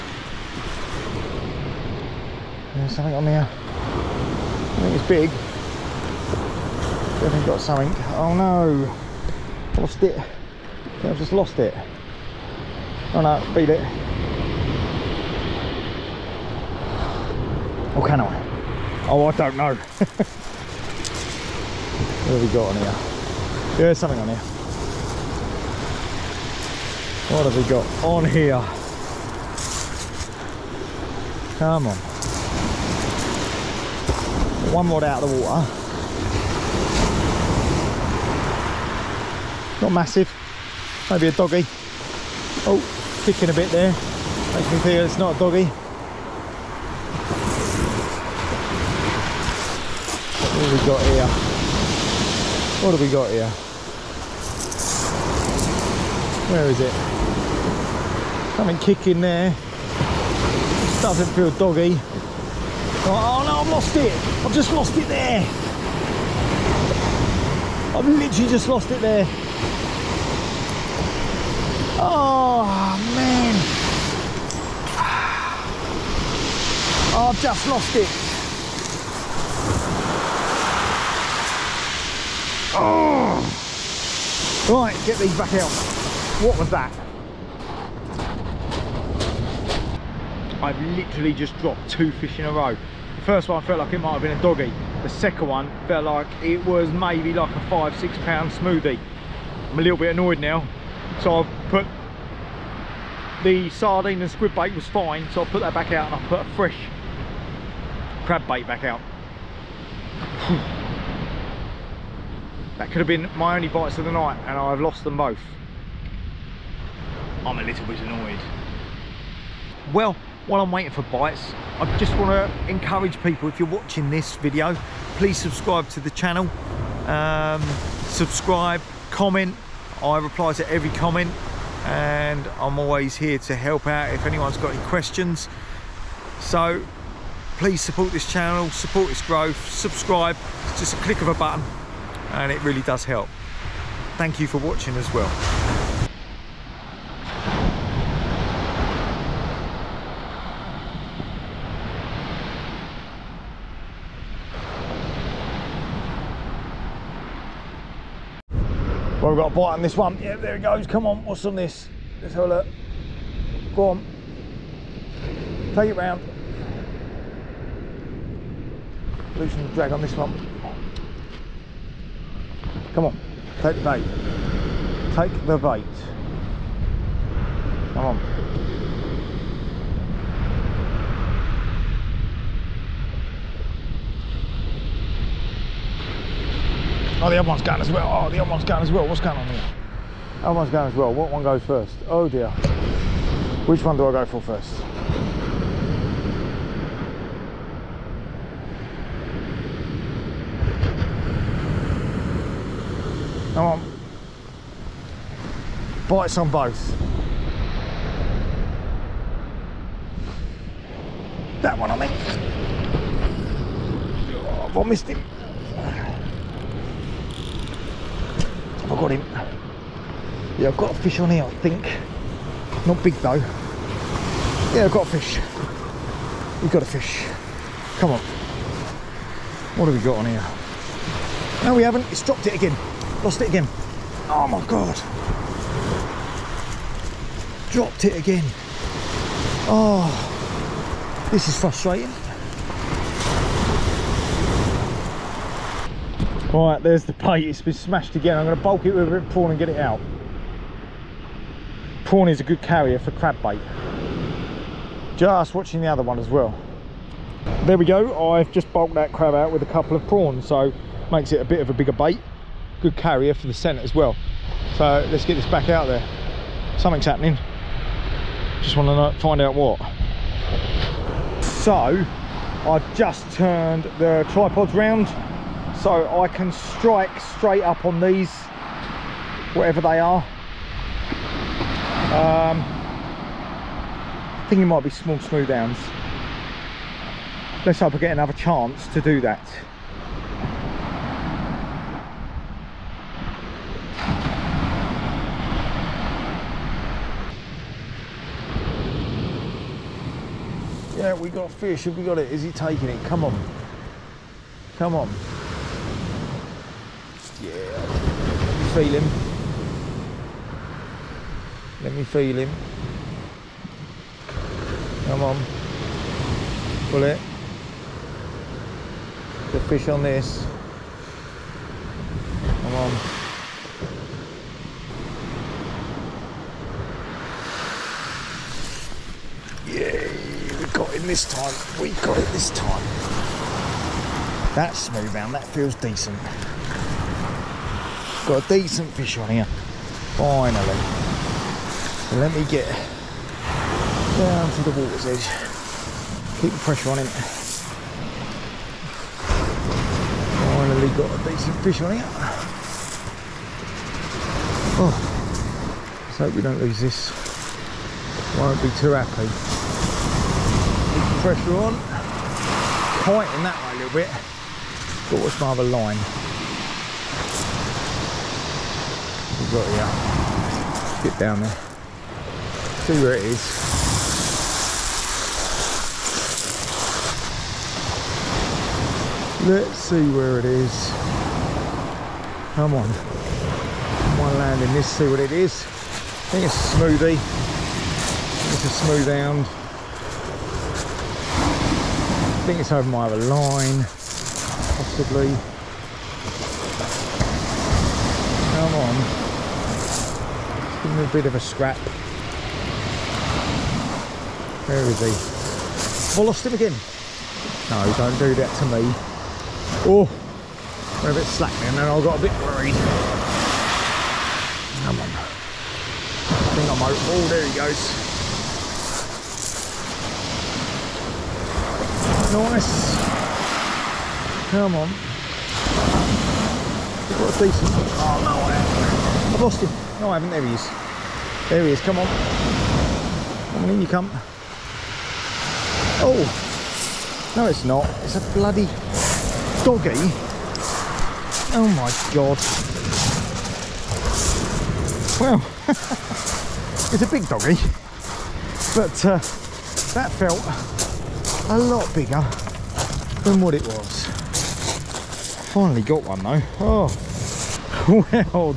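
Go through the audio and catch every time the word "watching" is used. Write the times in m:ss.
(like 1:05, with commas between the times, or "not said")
2:03, 2:24, 4:15.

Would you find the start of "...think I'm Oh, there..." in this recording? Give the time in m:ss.
6:56.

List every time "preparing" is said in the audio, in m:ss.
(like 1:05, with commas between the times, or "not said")
not said.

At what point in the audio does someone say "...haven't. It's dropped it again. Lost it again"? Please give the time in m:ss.
3:51.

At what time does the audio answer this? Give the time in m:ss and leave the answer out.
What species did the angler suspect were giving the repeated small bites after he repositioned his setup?
4:44.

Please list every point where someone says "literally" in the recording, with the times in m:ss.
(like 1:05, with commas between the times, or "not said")
1:08, 1:30.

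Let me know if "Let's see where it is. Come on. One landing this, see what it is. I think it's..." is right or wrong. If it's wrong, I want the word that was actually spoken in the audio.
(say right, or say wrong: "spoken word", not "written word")
right.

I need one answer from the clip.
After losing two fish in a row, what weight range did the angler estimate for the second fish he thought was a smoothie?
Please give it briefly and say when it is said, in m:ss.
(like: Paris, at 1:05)
5-6 pounds, at 1:37.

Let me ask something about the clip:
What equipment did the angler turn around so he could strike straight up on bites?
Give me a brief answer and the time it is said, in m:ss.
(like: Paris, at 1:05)
Tripods, at 4:34.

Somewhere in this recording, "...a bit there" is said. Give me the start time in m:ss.
0:43.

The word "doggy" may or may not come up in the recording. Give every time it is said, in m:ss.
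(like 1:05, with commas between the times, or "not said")
0:41, 0:45, 1:01, 1:34, 7:19, 7:27.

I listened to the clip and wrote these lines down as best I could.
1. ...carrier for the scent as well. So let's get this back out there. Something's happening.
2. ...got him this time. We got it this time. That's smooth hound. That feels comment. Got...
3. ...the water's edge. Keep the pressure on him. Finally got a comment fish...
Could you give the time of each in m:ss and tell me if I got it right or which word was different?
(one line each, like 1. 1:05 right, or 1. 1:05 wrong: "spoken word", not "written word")
1. 4:22 right
2. 5:30 wrong: "decent", not "comment"
3. 5:44 wrong: "decent", not "comment".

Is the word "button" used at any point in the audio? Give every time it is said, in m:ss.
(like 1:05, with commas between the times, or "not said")
2:21.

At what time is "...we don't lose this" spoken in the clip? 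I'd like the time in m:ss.
5:56.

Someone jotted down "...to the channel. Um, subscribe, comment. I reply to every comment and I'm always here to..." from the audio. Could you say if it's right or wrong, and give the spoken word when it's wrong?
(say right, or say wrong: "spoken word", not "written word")
right.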